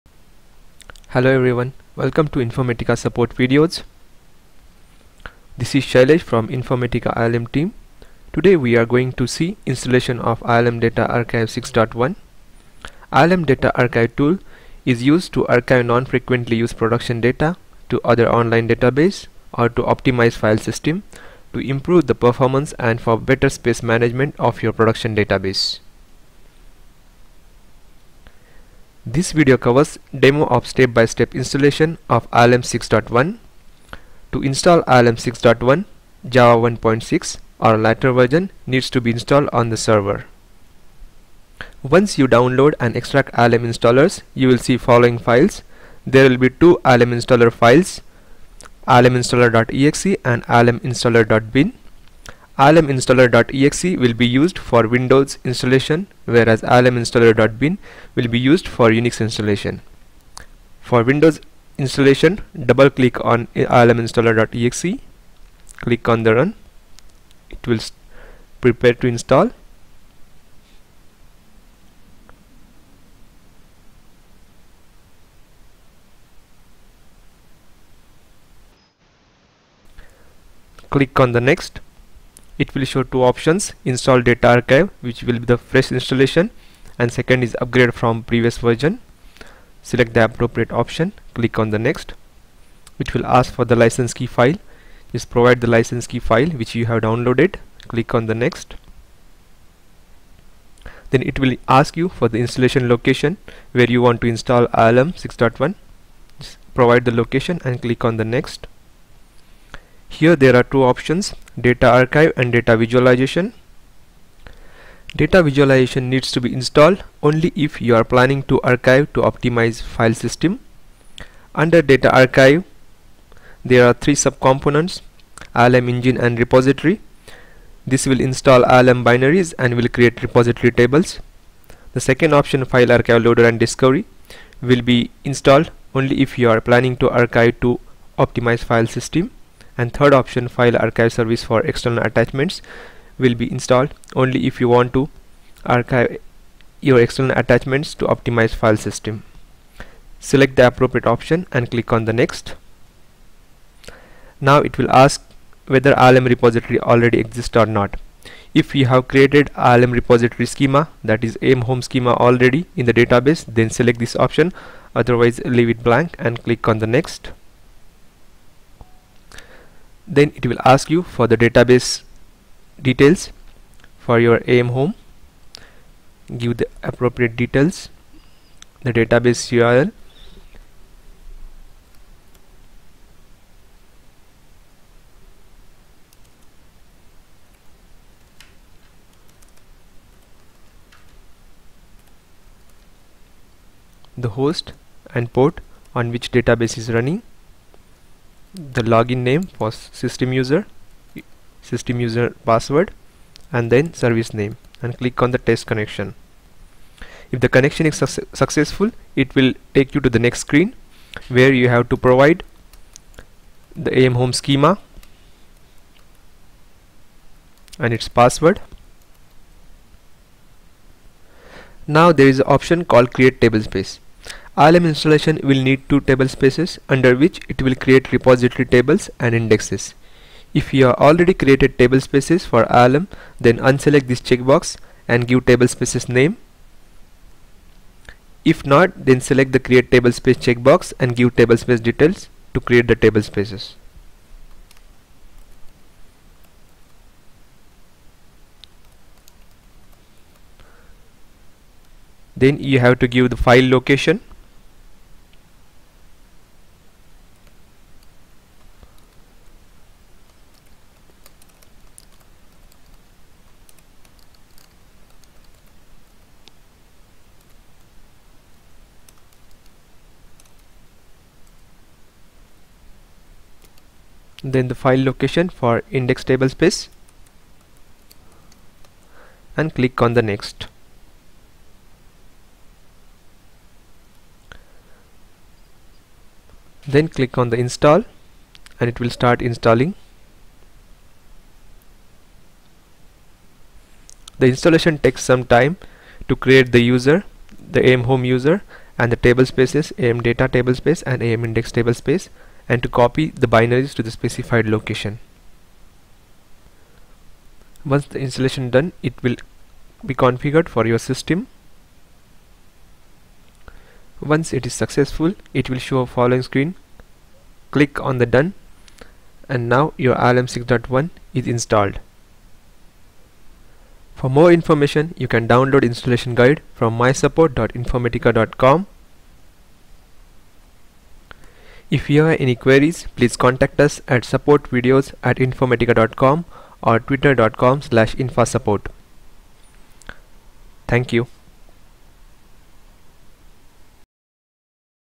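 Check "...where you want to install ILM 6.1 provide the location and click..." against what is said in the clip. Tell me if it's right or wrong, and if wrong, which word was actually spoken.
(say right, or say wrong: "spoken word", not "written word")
right.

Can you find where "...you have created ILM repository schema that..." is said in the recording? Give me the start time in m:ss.
2:38.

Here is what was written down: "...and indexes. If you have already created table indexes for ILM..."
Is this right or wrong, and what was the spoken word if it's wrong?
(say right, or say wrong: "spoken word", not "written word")
wrong: "spaces", not "indexes".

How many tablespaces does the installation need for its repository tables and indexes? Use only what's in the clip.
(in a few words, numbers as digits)
2.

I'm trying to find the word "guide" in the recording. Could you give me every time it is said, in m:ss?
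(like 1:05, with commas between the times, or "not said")
5:26.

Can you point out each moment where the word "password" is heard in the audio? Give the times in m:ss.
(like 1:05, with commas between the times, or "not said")
3:22, 3:38.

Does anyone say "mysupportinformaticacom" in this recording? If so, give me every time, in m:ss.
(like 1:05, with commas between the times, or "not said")
5:26.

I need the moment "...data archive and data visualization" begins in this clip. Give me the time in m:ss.
1:51.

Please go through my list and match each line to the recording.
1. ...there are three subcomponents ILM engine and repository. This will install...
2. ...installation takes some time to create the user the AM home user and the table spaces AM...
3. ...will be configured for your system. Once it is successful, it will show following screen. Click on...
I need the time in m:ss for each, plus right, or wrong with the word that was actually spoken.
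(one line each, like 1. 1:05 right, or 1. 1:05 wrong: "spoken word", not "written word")
1. 2:03 right
2. 4:54 right
3. 5:09 right.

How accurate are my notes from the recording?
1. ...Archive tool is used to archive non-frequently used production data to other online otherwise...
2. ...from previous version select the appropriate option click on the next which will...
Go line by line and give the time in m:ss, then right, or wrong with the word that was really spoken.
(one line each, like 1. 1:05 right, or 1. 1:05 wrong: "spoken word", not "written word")
1. 0:13 wrong: "database", not "otherwise"
2. 1:27 right.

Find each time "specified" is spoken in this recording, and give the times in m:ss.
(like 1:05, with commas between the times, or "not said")
5:04.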